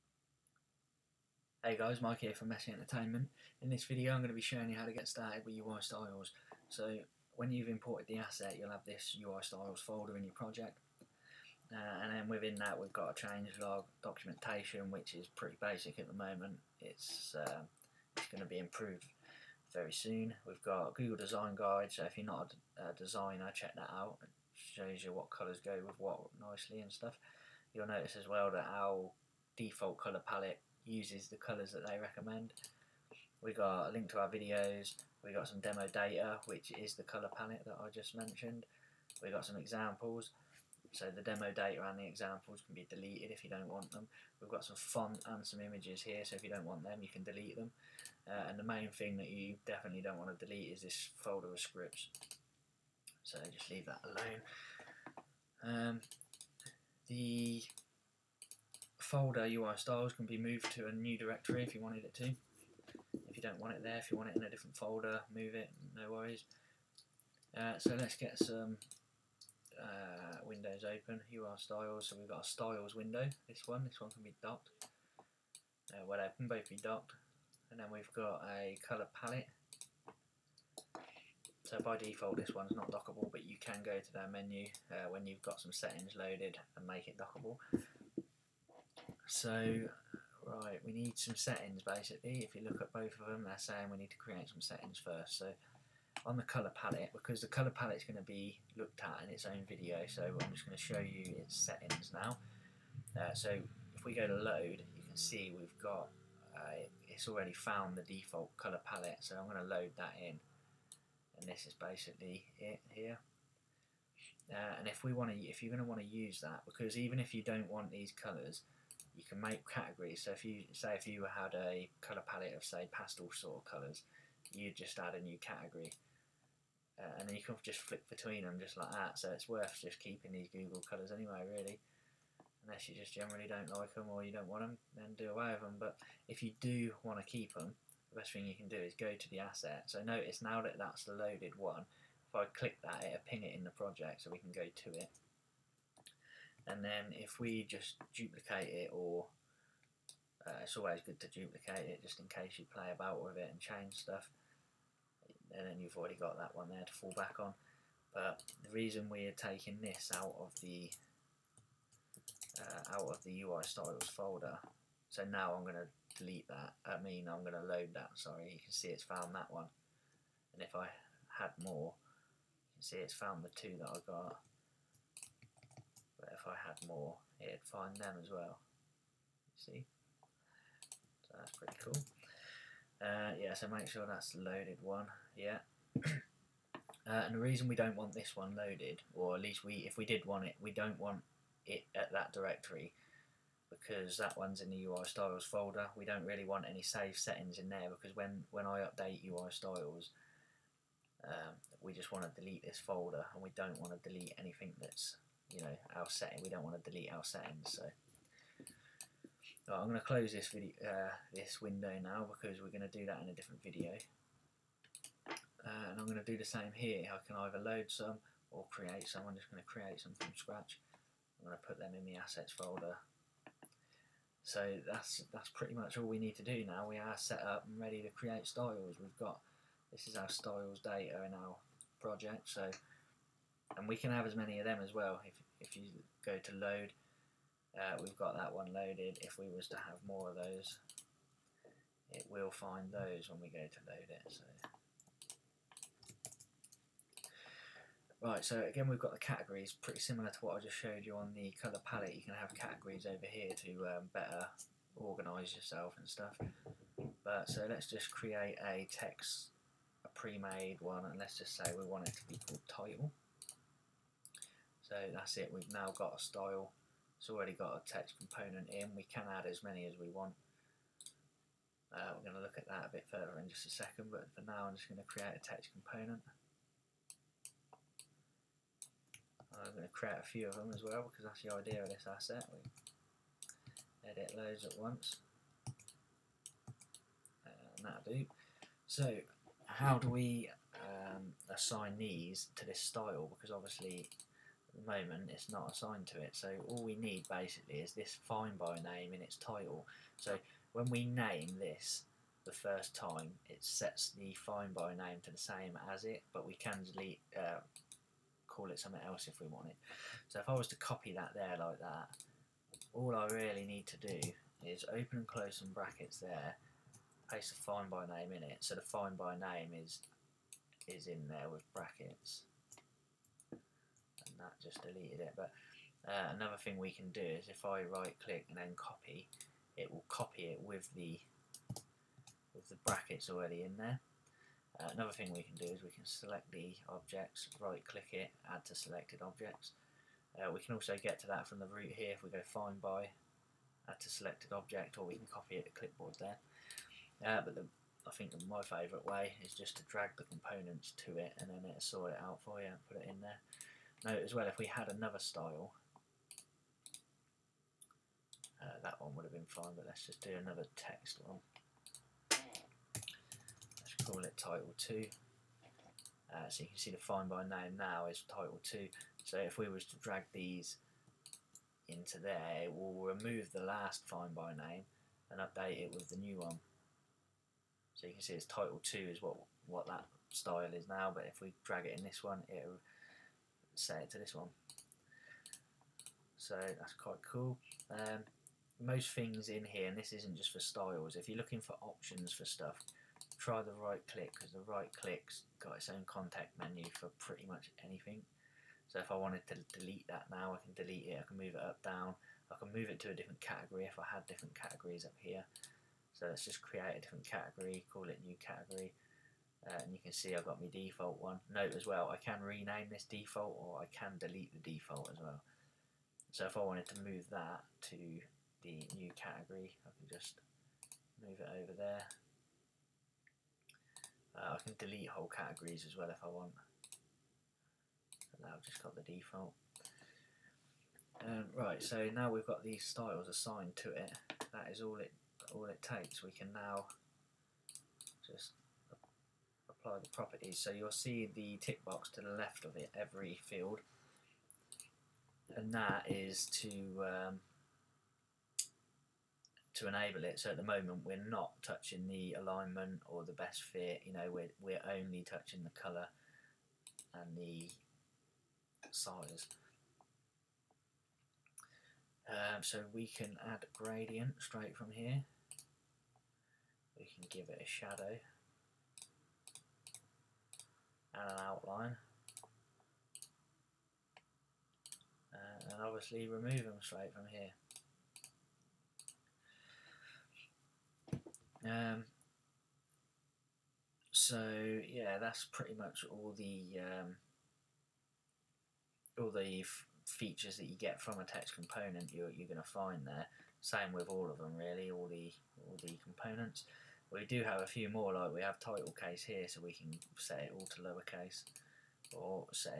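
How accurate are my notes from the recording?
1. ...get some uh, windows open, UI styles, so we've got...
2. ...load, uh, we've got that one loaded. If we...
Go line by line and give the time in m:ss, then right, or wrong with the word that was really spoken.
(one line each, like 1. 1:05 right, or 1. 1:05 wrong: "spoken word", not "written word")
1. 1:08 right
2. 3:56 right.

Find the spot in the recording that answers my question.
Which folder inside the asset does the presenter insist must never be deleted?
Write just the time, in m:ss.
0:51.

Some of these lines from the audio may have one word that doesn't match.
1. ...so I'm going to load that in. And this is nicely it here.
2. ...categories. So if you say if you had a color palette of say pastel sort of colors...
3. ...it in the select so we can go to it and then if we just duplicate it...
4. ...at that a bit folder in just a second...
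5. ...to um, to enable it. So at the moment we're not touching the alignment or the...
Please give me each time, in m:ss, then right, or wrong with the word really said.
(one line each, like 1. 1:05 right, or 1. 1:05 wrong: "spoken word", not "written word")
1. 1:49 wrong: "basically", not "nicely"
2. 1:59 right
3. 2:23 wrong: "project", not "select"
4. 4:32 wrong: "further", not "folder"
5. 7:26 right.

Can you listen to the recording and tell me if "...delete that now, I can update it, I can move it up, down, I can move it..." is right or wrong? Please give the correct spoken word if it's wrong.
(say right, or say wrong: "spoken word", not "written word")
wrong: "delete", not "update".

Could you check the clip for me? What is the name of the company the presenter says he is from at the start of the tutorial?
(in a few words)
Messy Entertainment.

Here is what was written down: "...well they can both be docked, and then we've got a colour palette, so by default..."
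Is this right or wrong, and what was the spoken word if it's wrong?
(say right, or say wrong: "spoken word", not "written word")
right.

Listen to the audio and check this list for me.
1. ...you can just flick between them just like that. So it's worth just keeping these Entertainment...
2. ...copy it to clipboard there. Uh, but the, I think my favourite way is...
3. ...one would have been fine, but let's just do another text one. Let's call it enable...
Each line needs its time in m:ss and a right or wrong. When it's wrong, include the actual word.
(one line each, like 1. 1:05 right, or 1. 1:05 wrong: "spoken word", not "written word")
1. 2:07 wrong: "Google", not "Entertainment"
2. 5:45 right
3. 5:58 wrong: "title", not "enable".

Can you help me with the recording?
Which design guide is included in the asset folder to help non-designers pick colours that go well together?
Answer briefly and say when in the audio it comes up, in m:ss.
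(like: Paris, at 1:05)
Google Design Guide, at 0:20.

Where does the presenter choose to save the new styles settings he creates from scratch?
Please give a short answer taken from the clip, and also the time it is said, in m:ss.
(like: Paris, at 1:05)
assets folder, at 3:42.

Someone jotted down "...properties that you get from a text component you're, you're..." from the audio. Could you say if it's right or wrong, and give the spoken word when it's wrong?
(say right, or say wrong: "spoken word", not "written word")
wrong: "features", not "properties".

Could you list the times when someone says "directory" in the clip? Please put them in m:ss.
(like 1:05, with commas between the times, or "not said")
1:01, 3:12.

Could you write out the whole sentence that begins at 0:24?
It shows you what colours go with what nicely and stuff.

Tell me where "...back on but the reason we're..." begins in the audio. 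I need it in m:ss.
2:37.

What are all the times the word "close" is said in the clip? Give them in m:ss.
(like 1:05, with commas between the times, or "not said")
3:30, 5:15.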